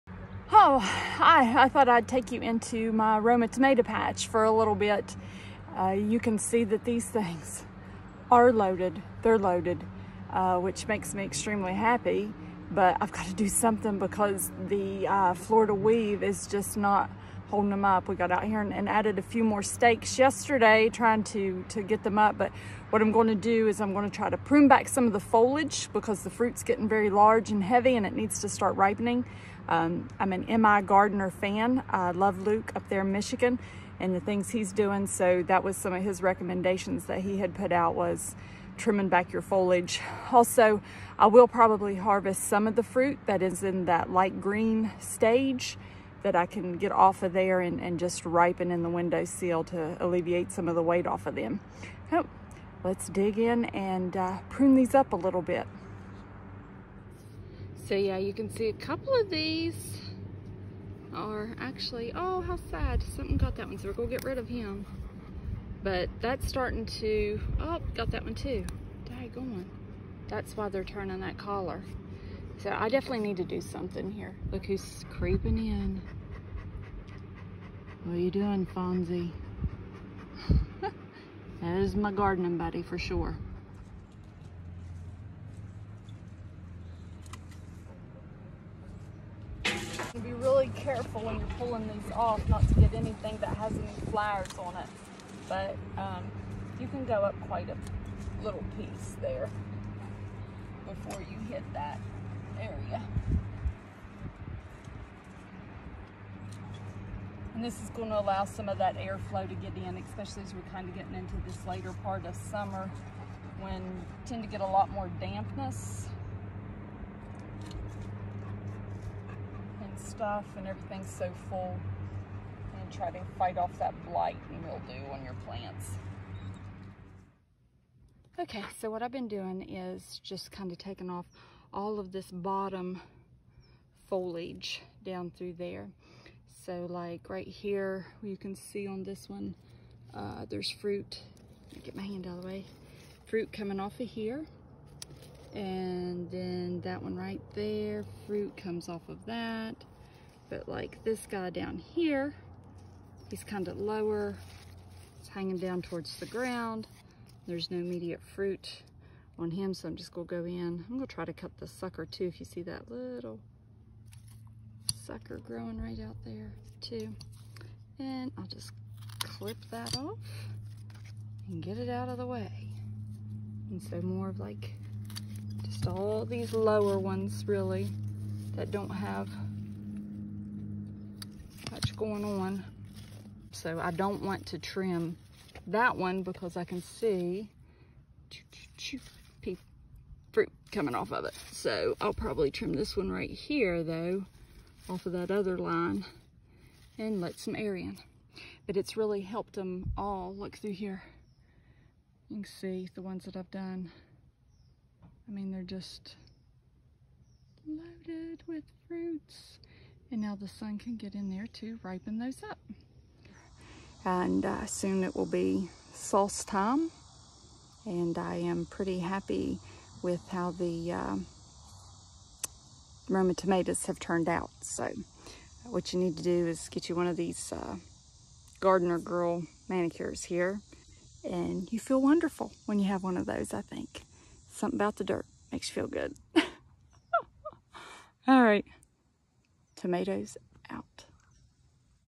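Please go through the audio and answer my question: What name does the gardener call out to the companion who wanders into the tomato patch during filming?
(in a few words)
Fonzie.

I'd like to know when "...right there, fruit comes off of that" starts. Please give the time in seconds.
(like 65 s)
147 s.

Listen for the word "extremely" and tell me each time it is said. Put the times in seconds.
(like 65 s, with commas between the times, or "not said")
11 s.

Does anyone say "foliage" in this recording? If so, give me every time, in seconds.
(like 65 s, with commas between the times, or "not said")
25 s, 39 s, 134 s.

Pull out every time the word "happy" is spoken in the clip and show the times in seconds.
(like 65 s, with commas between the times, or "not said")
11 s, 218 s.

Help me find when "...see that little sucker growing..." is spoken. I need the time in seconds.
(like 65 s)
162 s.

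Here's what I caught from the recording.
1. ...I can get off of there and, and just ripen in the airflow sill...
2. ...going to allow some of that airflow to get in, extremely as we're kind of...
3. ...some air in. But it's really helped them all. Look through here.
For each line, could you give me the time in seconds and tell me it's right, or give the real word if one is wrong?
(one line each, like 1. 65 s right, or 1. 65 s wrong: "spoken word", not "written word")
1. 46 s wrong: "window", not "airflow"
2. 107 s wrong: "especially", not "extremely"
3. 197 s right.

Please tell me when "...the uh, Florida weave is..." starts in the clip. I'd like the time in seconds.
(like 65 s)
14 s.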